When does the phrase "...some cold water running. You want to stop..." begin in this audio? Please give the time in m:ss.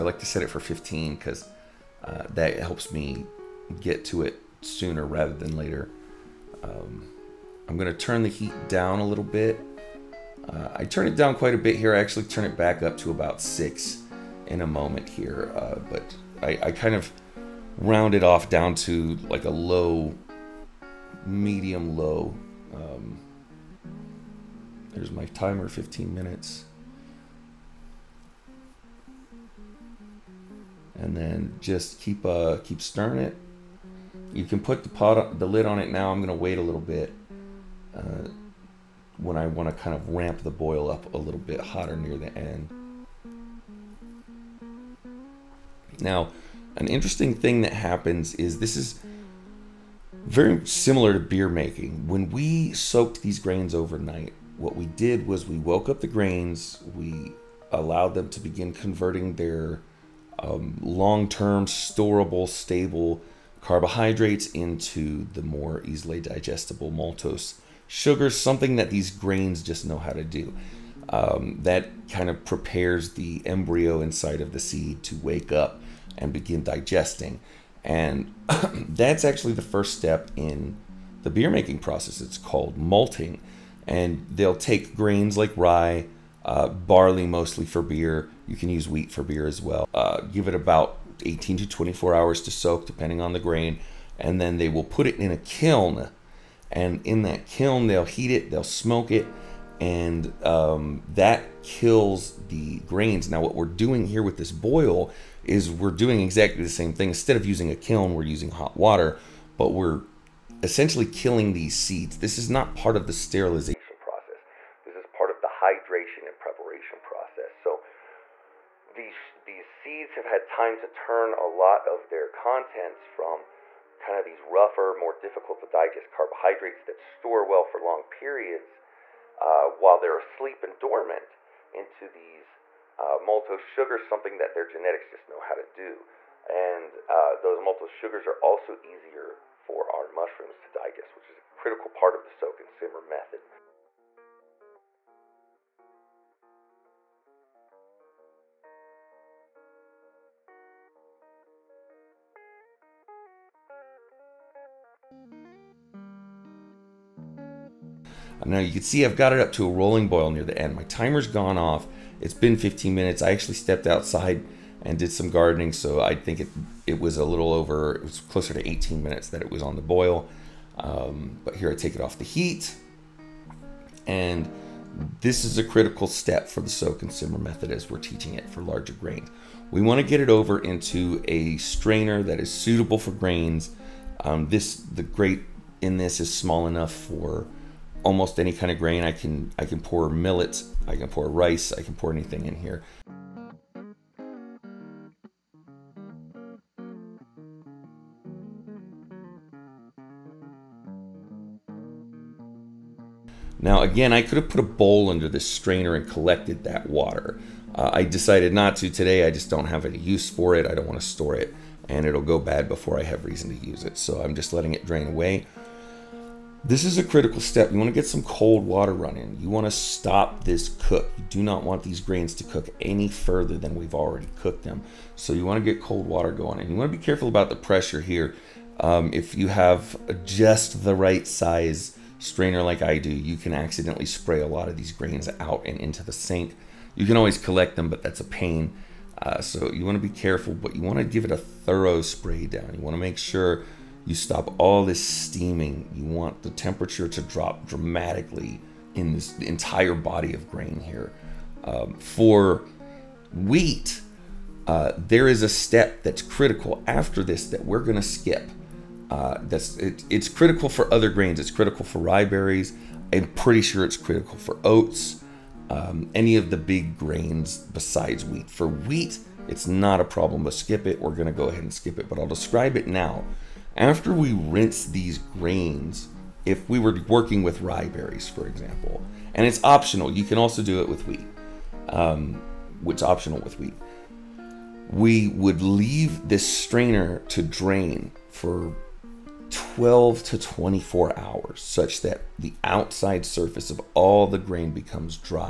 3:38.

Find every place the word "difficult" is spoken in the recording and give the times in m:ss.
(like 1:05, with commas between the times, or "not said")
2:05.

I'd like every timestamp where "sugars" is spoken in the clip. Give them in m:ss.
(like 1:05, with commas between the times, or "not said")
1:07, 2:13, 2:17.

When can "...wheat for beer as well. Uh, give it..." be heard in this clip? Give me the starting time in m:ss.
1:28.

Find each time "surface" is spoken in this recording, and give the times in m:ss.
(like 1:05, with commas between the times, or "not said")
4:53.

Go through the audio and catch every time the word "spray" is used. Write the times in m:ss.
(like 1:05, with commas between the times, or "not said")
3:54, 4:02.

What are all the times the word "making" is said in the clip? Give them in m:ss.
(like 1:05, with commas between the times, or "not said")
0:51, 1:21.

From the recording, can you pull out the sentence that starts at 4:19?
Uh, that's it, it's critical for other grains.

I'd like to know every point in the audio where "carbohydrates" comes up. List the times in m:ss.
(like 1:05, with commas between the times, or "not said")
1:03, 2:06.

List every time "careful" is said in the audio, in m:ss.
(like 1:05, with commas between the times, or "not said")
3:47, 4:00.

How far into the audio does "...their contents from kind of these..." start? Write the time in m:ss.
2:02.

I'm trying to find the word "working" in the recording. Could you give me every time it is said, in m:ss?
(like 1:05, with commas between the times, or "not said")
4:37.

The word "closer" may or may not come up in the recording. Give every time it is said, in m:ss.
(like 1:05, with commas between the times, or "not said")
2:48.